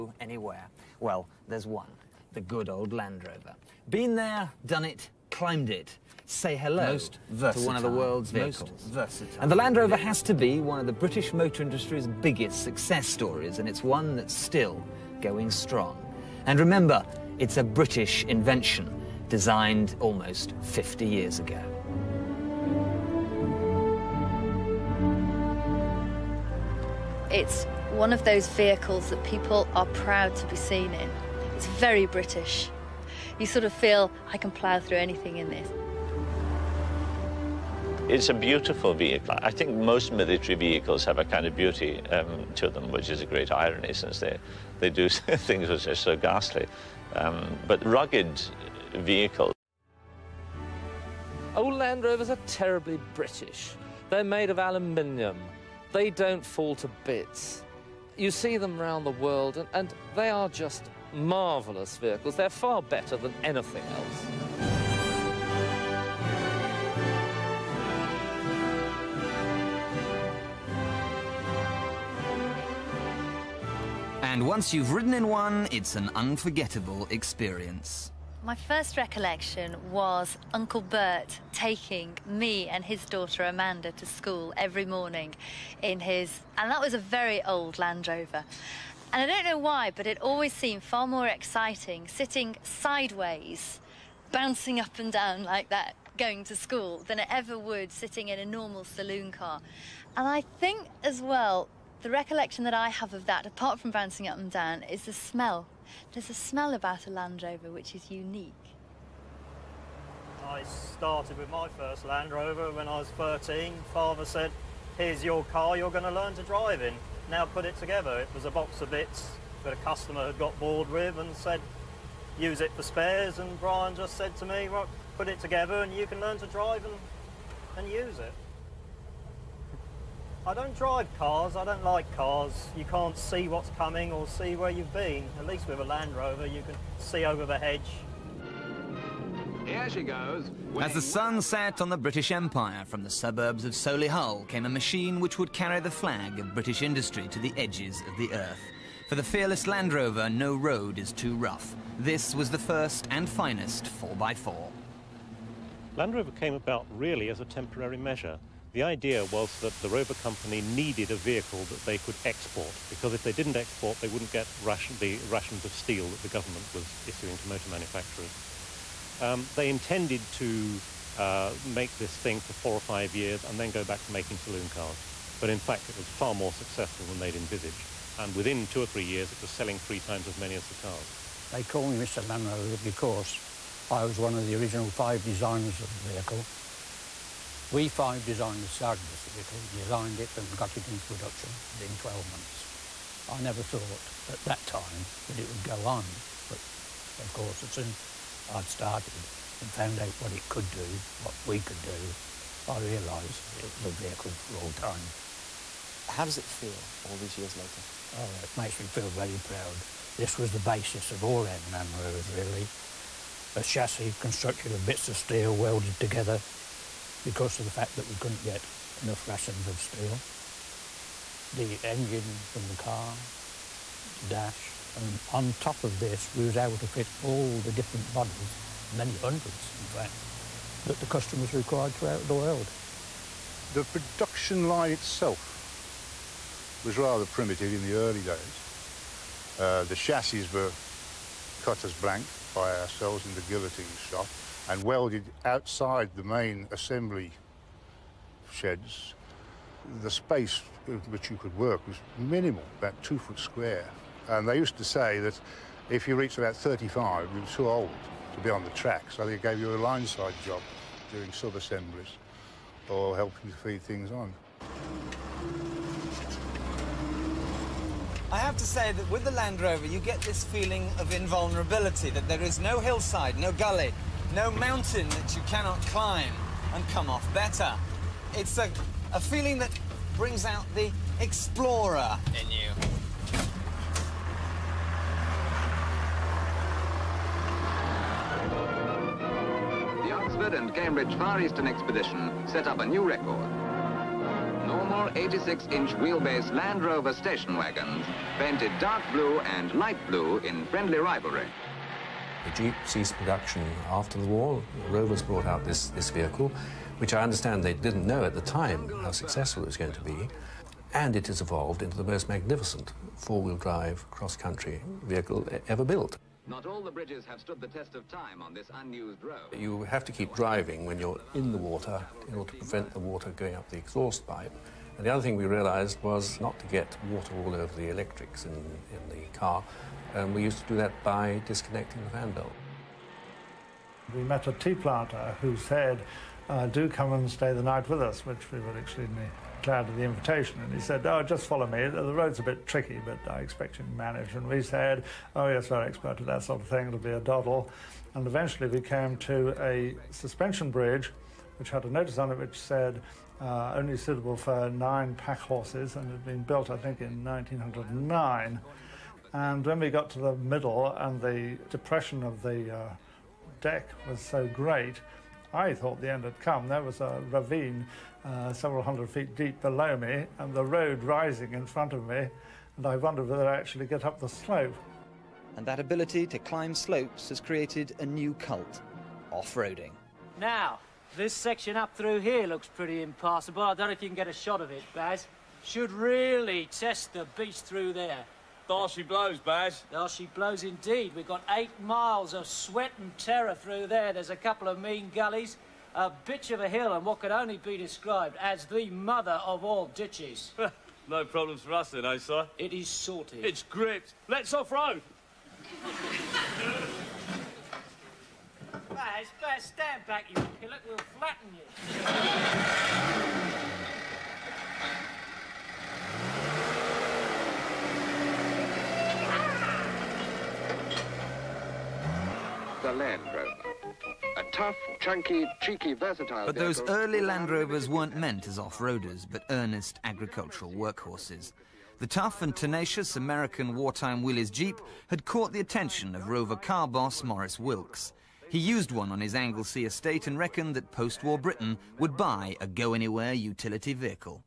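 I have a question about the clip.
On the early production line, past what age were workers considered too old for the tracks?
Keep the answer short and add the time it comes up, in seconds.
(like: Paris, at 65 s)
35, at 256 s.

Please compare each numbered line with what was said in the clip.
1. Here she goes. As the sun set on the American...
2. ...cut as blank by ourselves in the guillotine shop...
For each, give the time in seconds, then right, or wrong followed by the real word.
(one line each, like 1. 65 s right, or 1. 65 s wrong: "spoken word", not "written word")
1. 139 s wrong: "British", not "American"
2. 241 s right.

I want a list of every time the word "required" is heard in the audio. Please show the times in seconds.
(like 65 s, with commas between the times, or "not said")
231 s.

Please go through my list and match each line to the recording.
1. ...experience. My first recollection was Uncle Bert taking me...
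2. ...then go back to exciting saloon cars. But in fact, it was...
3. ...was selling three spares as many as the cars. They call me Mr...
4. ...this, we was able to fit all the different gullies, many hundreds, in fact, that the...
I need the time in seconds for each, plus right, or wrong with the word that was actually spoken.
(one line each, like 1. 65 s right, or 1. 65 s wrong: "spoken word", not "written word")
1. 77 s right
2. 173 s wrong: "making", not "exciting"
3. 179 s wrong: "times", not "spares"
4. 225 s wrong: "bodies", not "gullies".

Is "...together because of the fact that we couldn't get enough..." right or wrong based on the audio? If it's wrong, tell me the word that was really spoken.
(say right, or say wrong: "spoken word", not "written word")
right.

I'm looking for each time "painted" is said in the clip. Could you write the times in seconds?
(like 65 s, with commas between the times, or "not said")
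298 s.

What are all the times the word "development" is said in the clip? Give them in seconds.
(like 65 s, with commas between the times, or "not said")
not said.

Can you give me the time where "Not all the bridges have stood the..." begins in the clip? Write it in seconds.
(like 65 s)
316 s.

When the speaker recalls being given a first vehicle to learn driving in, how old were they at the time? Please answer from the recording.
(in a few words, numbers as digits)
13.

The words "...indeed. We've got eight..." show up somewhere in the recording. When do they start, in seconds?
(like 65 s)
390 s.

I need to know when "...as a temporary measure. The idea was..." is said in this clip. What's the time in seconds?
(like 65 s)
157 s.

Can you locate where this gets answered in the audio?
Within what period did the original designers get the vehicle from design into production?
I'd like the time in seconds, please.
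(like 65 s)
191 s.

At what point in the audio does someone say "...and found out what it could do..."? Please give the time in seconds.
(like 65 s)
199 s.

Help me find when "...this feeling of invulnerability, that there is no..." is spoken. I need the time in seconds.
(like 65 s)
270 s.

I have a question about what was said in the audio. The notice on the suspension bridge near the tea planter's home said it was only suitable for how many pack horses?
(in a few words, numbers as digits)
9.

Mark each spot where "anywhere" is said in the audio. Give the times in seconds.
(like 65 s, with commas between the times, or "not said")
0 s, 442 s.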